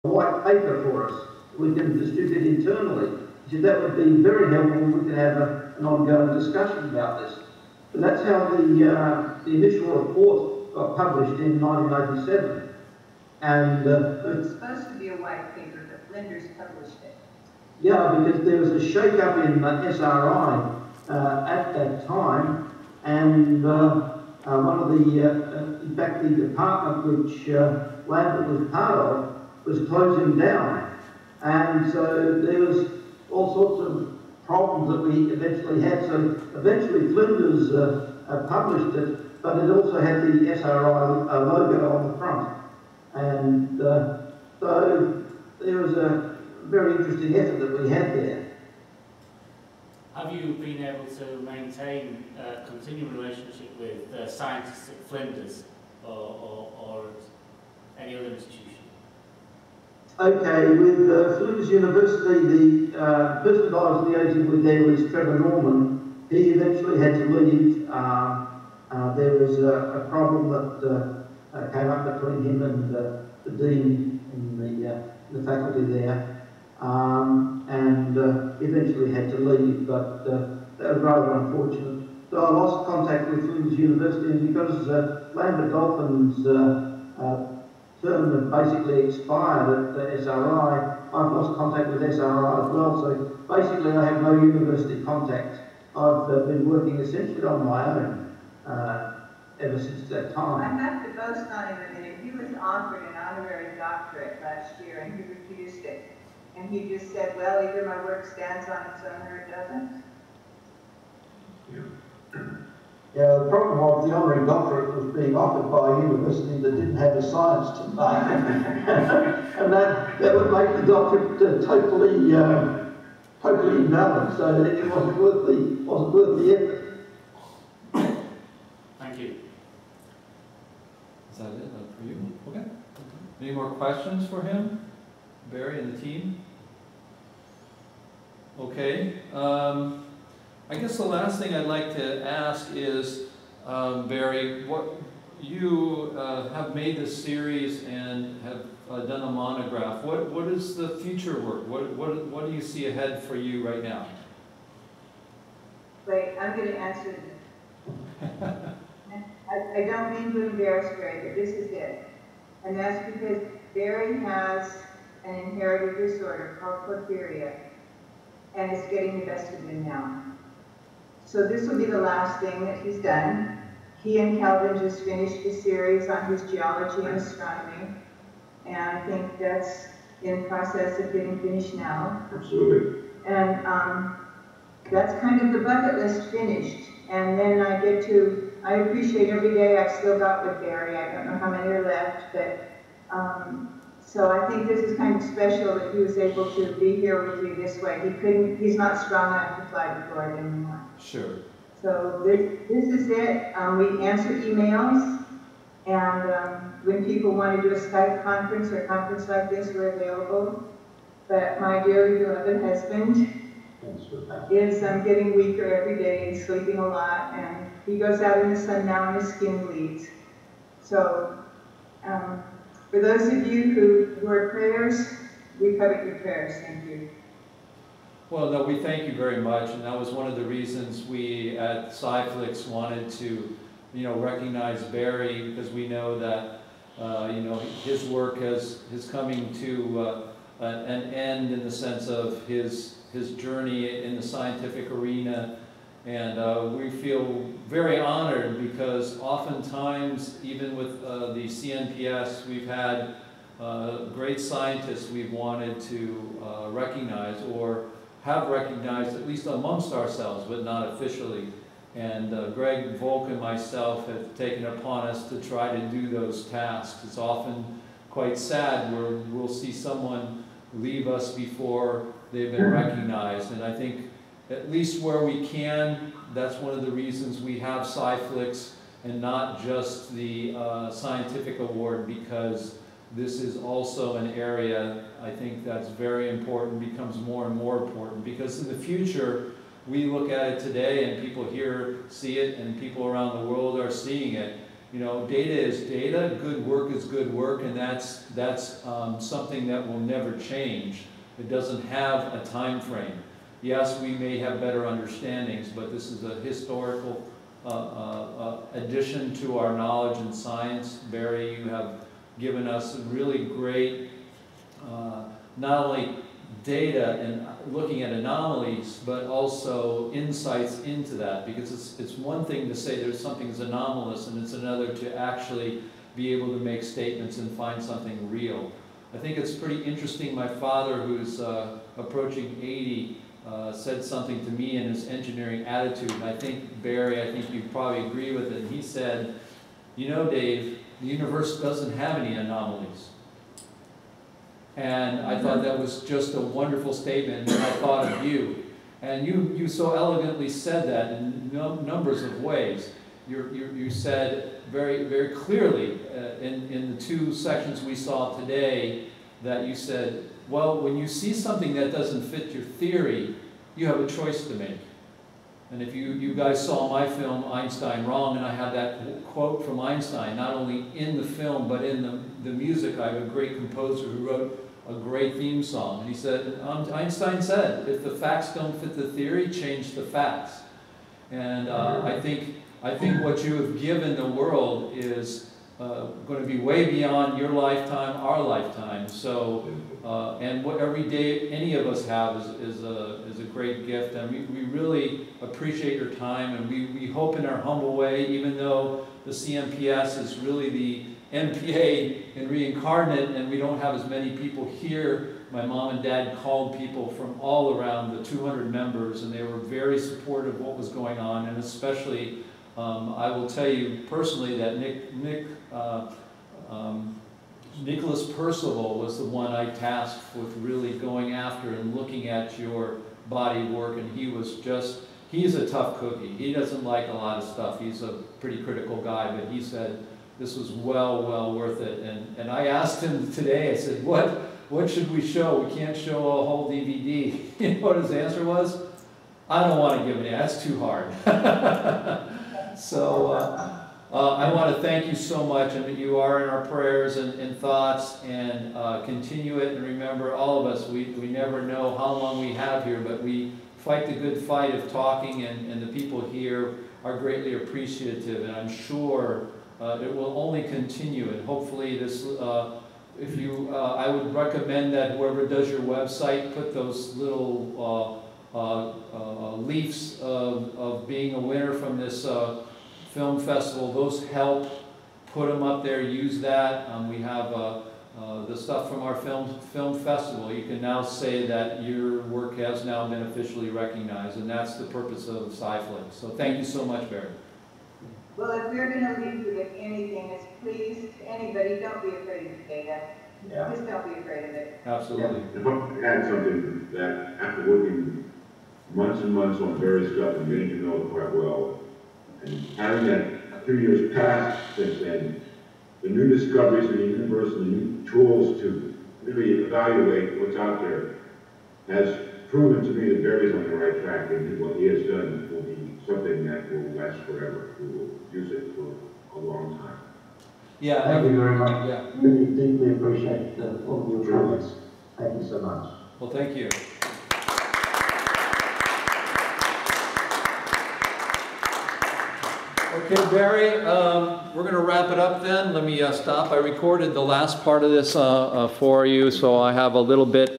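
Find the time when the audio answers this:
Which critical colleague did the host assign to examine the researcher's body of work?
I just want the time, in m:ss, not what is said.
6:57.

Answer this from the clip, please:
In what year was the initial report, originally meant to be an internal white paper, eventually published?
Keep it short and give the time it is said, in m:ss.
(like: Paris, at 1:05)
1987, at 0:11.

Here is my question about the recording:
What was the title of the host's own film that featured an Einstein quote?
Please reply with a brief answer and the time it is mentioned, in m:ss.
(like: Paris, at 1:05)
Einstein Wrong, at 6:07.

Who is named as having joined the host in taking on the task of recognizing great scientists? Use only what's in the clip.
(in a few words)
Greg Volk.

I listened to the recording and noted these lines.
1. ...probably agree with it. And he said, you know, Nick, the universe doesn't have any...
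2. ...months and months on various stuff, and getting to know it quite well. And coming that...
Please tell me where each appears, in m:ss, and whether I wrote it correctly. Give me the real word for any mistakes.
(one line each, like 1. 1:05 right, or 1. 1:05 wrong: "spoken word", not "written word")
1. 5:37 wrong: "Dave", not "Nick"
2. 8:18 wrong: "having", not "coming".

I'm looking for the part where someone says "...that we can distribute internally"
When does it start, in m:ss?
0:01.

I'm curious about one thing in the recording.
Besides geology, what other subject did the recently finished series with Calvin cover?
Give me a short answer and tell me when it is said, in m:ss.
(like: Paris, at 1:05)
Astronomy, at 2:57.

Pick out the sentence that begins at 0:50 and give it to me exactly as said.
Have you been able to maintain a uh, continuing relationship with uh, scientists at Flinders or, or, or any other institution?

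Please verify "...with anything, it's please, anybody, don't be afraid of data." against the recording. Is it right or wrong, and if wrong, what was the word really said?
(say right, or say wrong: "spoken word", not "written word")
right.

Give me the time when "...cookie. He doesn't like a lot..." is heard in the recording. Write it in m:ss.
7:05.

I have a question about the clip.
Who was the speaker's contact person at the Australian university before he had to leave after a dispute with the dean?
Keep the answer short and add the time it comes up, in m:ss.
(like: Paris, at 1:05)
Trevor Norman, at 1:05.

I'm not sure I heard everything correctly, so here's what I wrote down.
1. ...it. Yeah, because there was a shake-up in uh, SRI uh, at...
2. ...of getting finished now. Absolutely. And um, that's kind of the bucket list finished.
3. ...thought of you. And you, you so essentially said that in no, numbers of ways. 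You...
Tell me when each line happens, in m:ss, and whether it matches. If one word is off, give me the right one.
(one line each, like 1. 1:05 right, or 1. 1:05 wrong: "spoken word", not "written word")
1. 0:17 right
2. 3:00 right
3. 5:47 wrong: "elegantly", not "essentially".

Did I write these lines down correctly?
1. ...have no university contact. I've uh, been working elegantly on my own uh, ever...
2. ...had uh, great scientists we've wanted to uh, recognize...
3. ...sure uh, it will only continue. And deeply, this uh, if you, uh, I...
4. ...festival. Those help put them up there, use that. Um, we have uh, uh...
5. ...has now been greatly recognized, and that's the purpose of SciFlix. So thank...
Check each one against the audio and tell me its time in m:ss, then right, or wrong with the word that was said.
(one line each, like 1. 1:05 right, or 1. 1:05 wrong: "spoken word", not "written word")
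1. 1:34 wrong: "essentially", not "elegantly"
2. 4:12 right
3. 7:38 wrong: "hopefully", not "deeply"
4. 7:53 right
5. 8:02 wrong: "officially", not "greatly".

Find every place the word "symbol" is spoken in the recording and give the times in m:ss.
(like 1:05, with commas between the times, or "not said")
not said.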